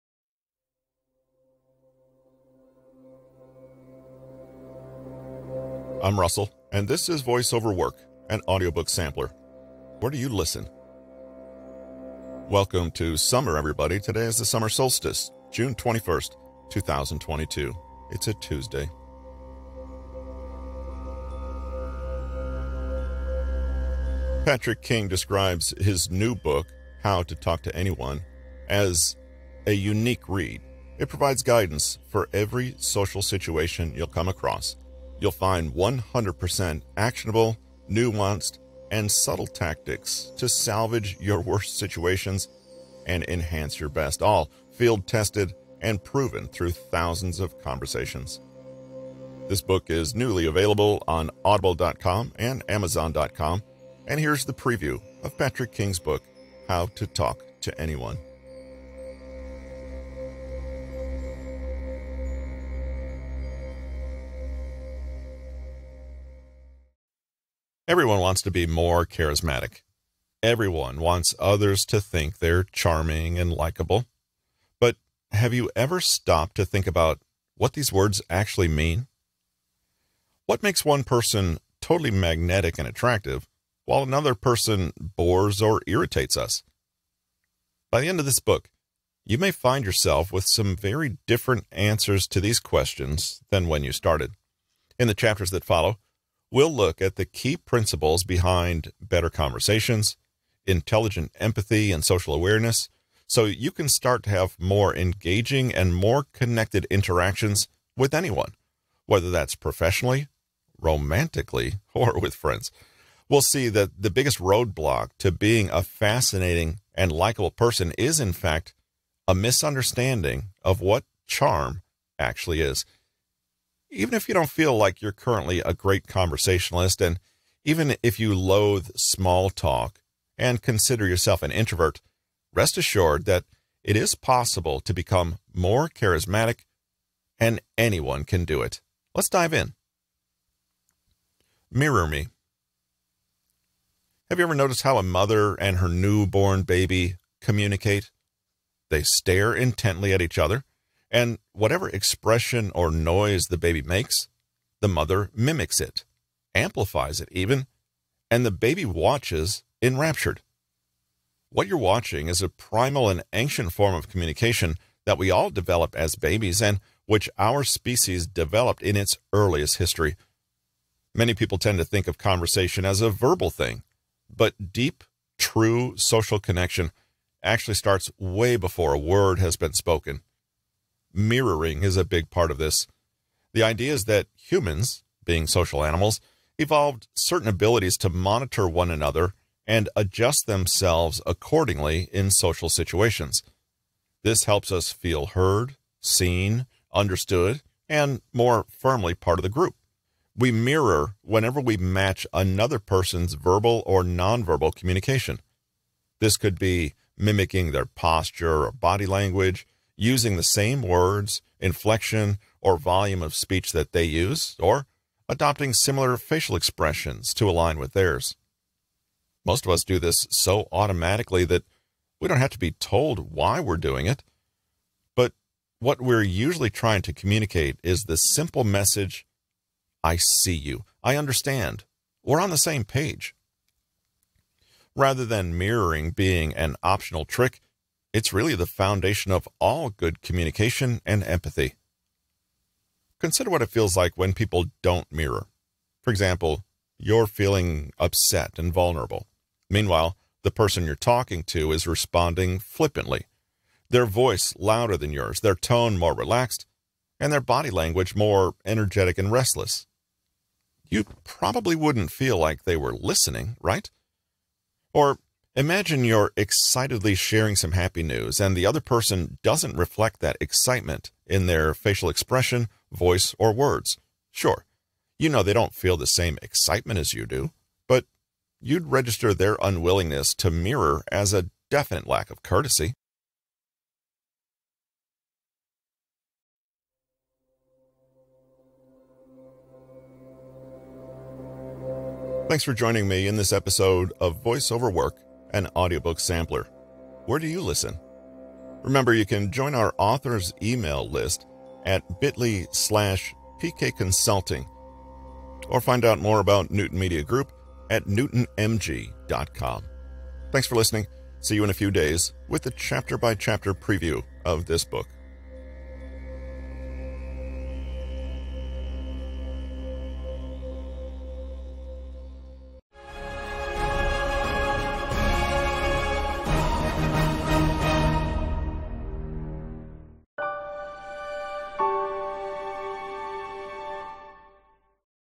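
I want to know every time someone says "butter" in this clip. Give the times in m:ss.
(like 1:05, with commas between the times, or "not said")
not said.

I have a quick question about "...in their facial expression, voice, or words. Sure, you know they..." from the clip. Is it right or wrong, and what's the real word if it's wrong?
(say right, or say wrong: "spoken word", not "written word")
right.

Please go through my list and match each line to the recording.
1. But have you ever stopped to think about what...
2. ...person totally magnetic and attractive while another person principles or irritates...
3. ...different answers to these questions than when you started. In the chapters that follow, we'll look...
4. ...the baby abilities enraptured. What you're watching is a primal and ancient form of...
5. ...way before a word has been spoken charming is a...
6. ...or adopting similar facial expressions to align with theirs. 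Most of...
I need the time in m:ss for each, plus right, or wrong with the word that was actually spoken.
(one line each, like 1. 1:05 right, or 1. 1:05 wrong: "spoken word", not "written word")
1. 1:14 right
2. 1:21 wrong: "bores", not "principles"
3. 1:31 right
4. 2:38 wrong: "watches", not "abilities"
5. 2:58 wrong: "mirroring", not "charming"
6. 3:34 right.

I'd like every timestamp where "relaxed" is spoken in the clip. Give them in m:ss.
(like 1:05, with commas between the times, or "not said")
4:16.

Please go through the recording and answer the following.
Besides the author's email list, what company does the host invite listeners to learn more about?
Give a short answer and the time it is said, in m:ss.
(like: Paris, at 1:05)
Newton Media Group, at 5:06.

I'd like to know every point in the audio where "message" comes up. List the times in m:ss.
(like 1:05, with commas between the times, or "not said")
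3:48.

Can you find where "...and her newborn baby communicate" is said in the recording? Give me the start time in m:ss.
2:25.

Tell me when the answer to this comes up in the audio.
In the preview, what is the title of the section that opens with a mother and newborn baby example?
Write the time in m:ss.
2:21.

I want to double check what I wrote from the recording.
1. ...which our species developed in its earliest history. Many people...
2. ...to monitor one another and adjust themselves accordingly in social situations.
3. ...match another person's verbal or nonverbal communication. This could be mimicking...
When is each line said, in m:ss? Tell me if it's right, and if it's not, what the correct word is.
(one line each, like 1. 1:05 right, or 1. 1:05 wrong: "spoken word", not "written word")
1. 2:47 right
2. 3:07 right
3. 3:21 right.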